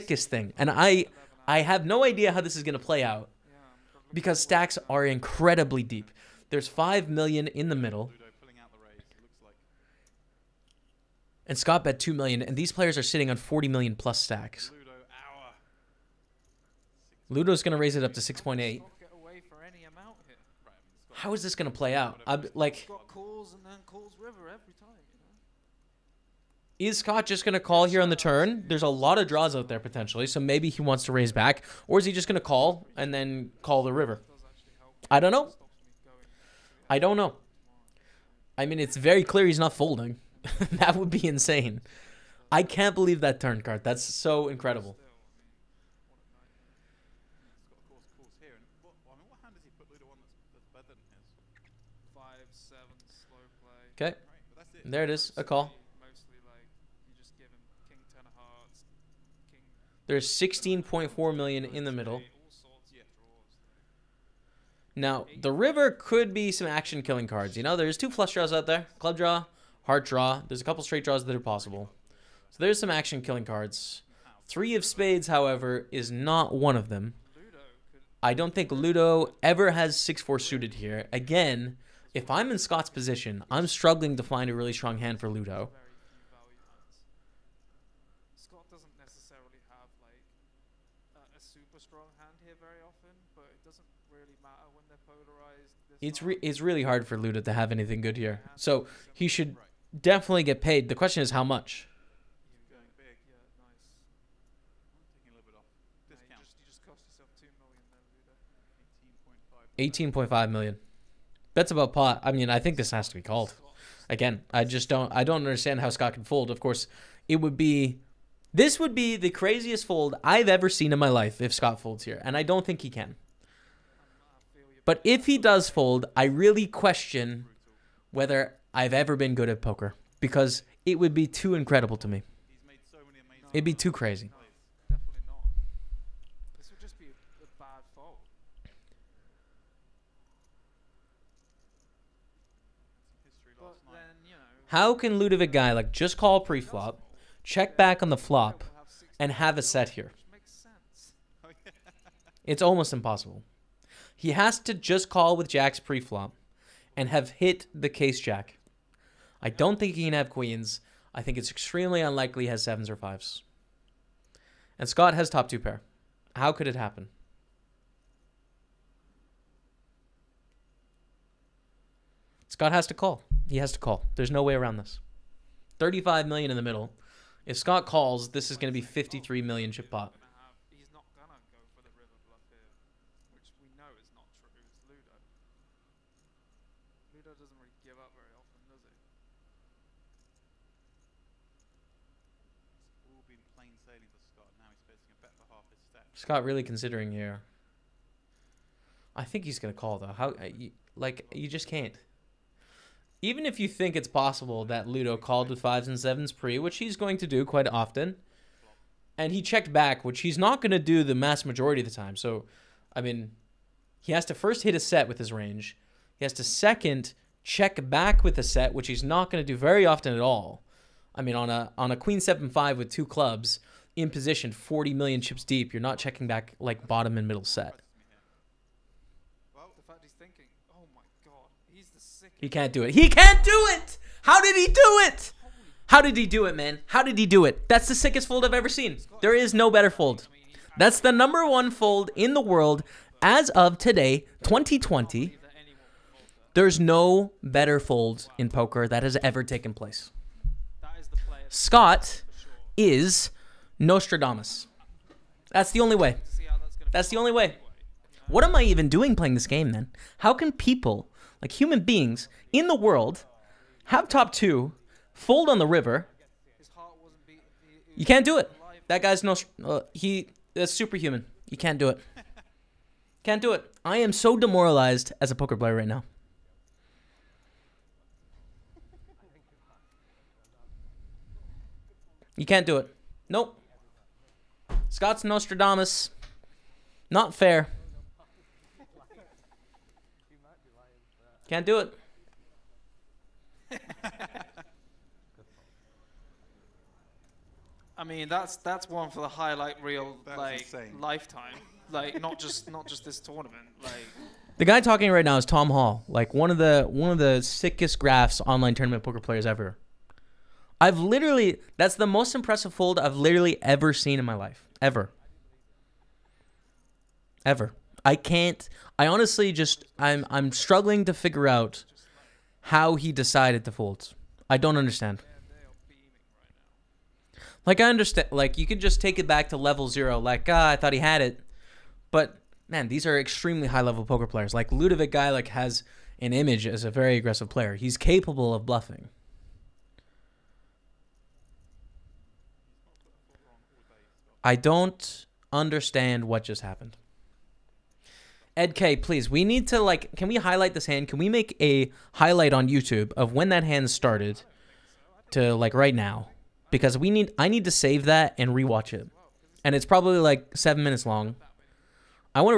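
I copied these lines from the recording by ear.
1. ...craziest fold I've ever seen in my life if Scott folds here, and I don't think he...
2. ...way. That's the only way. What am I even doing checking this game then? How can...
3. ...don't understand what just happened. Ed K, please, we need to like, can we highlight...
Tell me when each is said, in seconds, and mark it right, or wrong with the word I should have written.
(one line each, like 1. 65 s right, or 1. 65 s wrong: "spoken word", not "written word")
1. 119 s right
2. 255 s wrong: "playing", not "checking"
3. 344 s right.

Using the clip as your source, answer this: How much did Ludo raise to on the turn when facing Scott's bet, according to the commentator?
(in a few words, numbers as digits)
6.8 million.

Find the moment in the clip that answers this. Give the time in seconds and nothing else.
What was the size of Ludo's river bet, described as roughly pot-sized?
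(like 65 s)
109 s.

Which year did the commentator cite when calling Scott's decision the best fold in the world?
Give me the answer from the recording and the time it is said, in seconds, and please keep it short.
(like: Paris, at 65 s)
2020, at 244 s.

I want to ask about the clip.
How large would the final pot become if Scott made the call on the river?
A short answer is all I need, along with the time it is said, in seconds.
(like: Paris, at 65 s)
53 million, at 178 s.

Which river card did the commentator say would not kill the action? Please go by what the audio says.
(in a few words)
Three of spades.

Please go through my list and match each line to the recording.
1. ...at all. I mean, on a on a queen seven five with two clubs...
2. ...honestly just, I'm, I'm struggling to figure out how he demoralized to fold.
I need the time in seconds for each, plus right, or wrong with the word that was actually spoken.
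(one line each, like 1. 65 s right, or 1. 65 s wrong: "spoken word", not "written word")
1. 220 s right
2. 319 s wrong: "decided", not "demoralized".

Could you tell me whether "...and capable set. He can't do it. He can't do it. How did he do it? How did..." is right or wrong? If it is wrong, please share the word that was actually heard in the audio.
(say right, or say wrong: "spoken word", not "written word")
wrong: "middle", not "capable".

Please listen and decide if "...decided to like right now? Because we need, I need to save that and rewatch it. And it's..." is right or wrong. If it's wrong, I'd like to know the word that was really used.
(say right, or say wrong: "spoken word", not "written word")
wrong: "started", not "decided".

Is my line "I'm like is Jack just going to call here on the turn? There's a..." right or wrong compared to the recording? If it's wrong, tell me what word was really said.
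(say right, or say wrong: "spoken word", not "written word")
wrong: "Scott", not "Jack".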